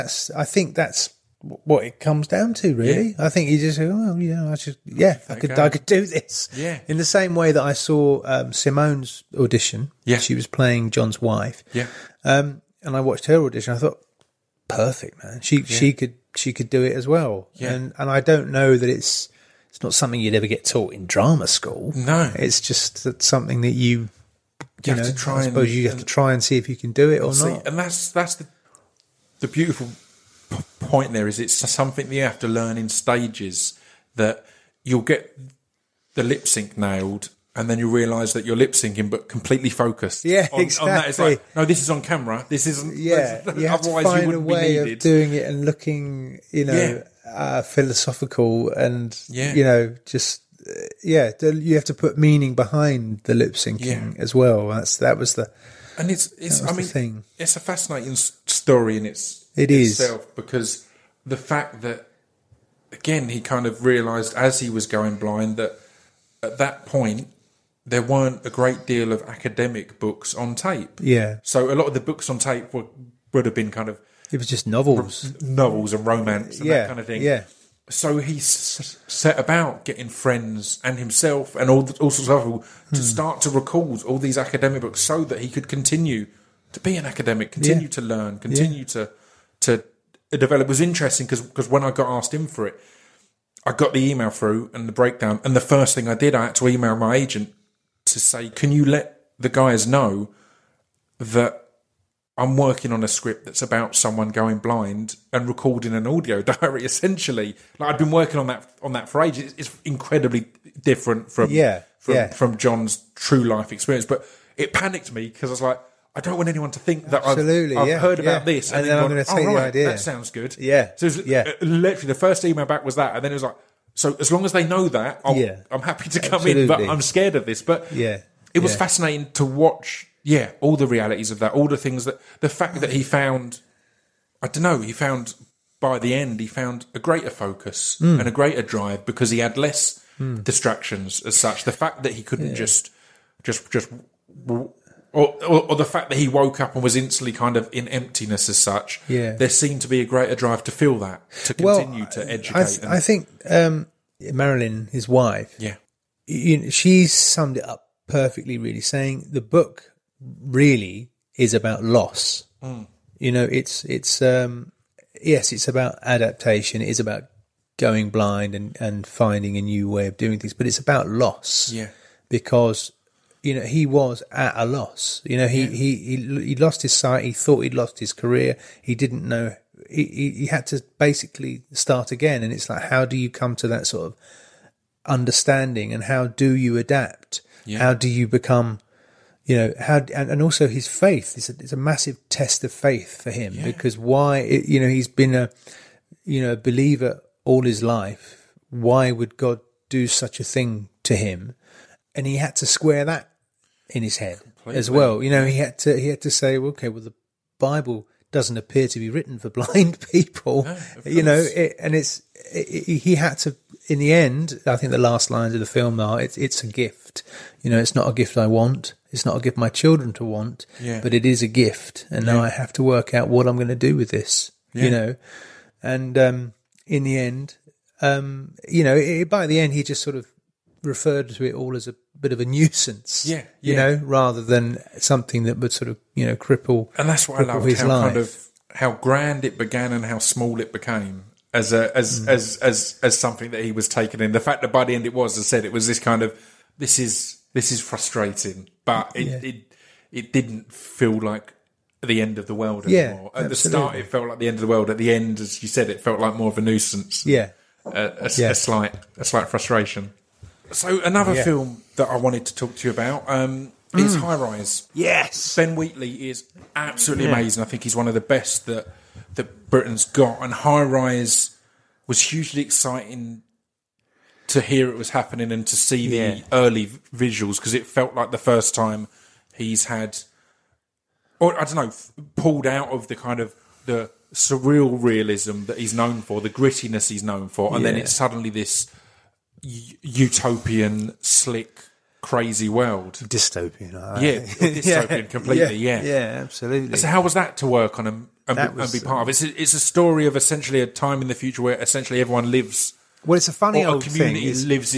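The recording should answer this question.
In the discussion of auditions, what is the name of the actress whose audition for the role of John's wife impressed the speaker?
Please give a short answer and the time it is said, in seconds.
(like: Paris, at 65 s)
Simone, at 8 s.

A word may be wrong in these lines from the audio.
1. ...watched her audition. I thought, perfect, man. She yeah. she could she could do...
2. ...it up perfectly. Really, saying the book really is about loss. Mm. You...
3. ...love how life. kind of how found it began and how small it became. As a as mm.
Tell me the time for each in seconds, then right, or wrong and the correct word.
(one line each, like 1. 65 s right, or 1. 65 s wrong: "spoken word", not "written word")
1. 13 s right
2. 157 s right
3. 237 s wrong: "grand", not "found".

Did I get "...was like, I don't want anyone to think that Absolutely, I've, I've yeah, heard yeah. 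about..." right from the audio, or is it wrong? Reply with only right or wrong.
right.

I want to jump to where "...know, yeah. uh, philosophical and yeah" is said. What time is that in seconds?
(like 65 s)
46 s.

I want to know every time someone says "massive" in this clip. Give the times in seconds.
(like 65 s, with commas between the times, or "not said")
191 s.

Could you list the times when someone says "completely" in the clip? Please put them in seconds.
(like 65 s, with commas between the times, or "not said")
39 s, 204 s, 295 s.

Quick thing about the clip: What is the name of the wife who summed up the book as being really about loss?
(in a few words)
Marilyn.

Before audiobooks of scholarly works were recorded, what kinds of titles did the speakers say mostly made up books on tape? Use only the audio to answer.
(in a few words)
novels and romance.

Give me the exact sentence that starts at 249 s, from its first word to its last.
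it, it didn't feel like the end of the world anymore.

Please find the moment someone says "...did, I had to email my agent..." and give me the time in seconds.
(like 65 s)
96 s.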